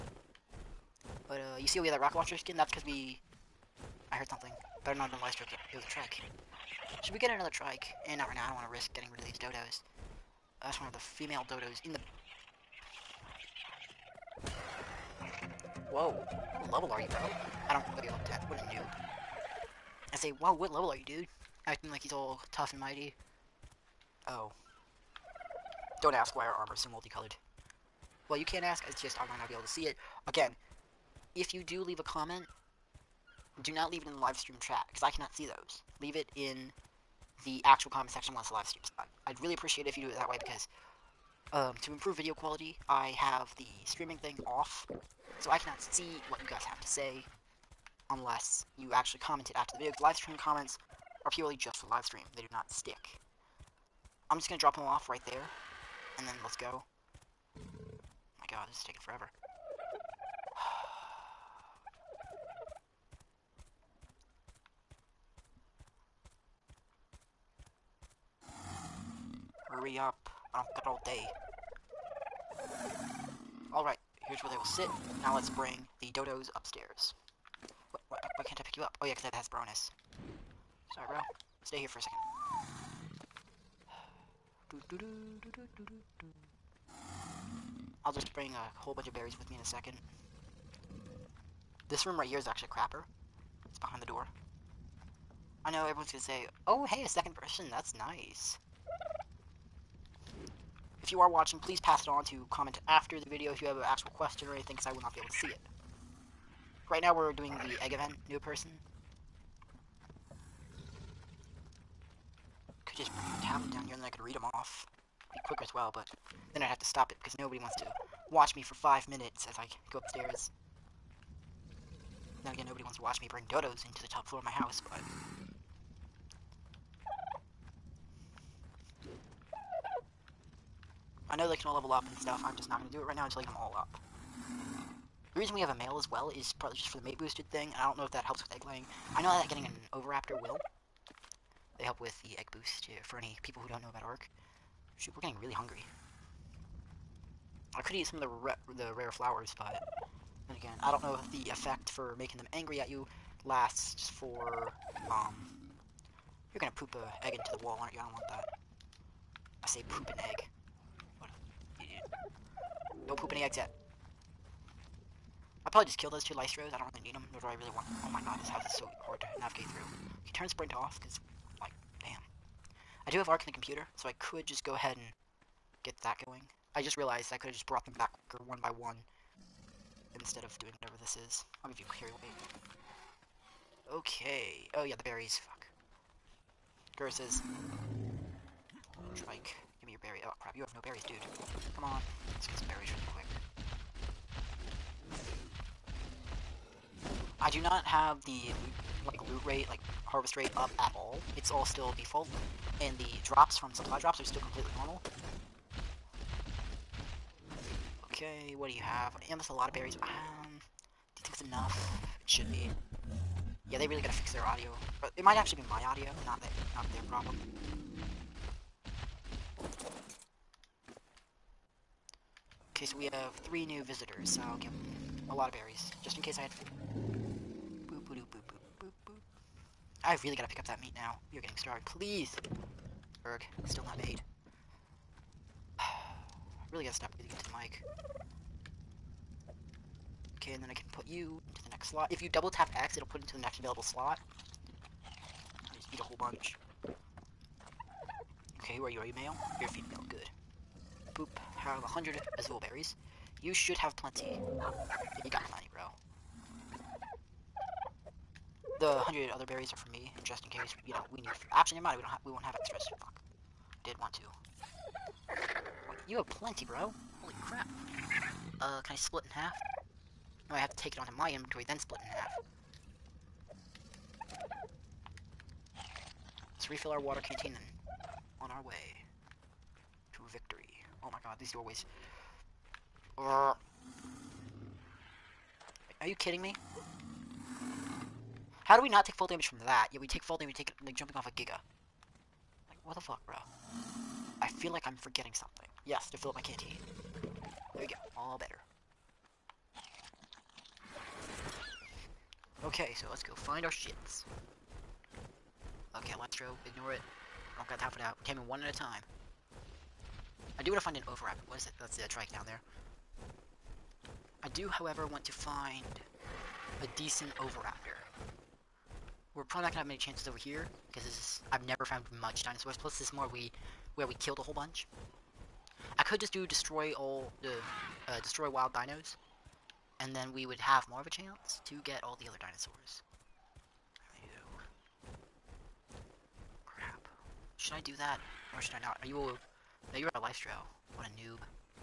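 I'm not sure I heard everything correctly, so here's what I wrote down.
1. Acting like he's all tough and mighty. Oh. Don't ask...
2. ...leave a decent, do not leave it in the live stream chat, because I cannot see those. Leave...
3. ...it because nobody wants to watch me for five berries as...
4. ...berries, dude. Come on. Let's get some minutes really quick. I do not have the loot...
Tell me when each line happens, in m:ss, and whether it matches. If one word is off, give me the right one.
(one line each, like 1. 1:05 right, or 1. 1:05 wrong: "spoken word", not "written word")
1. 0:21 right
2. 0:31 wrong: "comment", not "decent"
3. 1:57 wrong: "minutes", not "berries"
4. 3:10 wrong: "berries", not "minutes".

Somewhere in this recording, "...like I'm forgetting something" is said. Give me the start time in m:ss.
4:54.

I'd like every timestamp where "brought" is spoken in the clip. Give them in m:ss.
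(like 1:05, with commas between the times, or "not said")
2:57.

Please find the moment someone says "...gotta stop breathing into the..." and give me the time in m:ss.
3:56.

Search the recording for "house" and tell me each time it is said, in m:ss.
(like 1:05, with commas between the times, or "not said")
2:04, 2:48.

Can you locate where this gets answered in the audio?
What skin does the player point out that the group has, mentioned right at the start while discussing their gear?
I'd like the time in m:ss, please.
0:01.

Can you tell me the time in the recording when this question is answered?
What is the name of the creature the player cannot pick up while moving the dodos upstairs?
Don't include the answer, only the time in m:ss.
1:19.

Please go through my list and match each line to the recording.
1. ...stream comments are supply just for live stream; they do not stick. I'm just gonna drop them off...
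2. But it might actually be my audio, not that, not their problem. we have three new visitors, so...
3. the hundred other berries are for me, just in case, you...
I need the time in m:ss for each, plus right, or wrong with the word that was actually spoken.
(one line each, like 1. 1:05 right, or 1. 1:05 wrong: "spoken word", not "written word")
1. 0:50 wrong: "purely", not "supply"
2. 3:35 right
3. 4:18 right.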